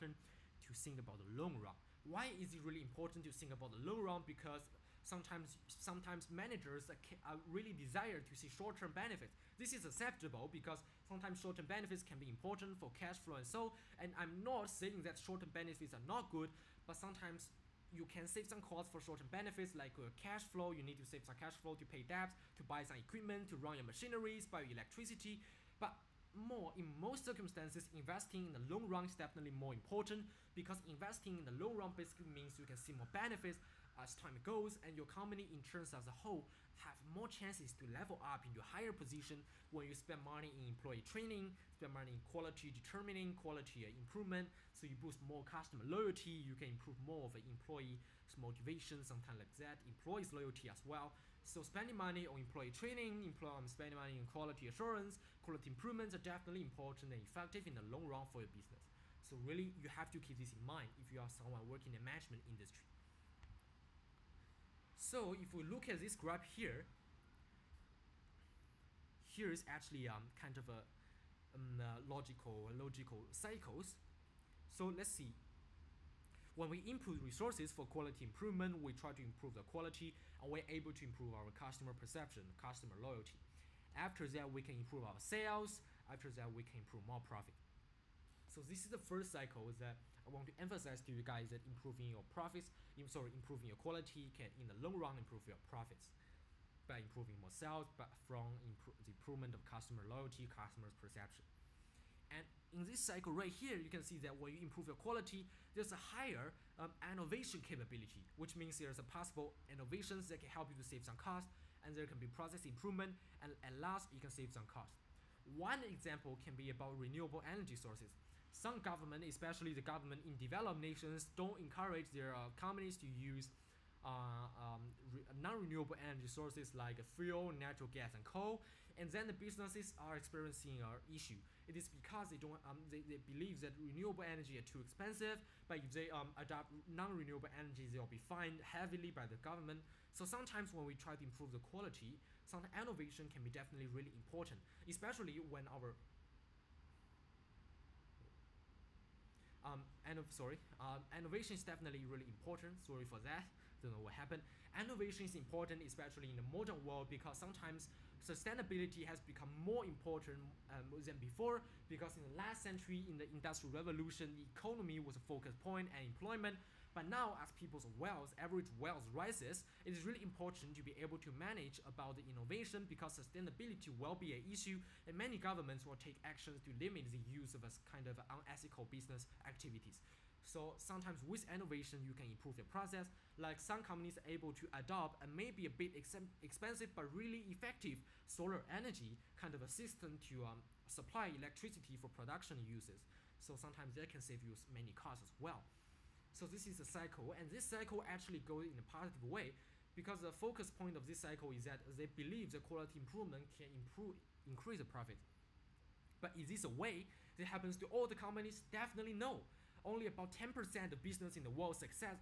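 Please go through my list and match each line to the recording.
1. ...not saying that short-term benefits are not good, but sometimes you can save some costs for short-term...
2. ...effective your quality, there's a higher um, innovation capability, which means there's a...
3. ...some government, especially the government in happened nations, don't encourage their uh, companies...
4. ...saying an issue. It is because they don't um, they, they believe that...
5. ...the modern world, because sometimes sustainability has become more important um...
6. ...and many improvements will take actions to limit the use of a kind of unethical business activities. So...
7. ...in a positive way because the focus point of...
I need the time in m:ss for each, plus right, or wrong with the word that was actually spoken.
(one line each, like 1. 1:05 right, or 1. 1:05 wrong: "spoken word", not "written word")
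1. 0:14 right
2. 1:44 wrong: "improve", not "effective"
3. 1:58 wrong: "developed", not "happened"
4. 2:10 wrong: "experiencing", not "saying"
5. 2:36 right
6. 2:55 wrong: "governments", not "improvements"
7. 3:18 right.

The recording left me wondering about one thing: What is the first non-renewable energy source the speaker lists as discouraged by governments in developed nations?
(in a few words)
Fuel.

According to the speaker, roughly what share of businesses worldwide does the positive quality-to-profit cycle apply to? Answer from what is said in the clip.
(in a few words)
10%.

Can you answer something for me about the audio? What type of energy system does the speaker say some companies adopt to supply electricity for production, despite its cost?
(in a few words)
Solar energy.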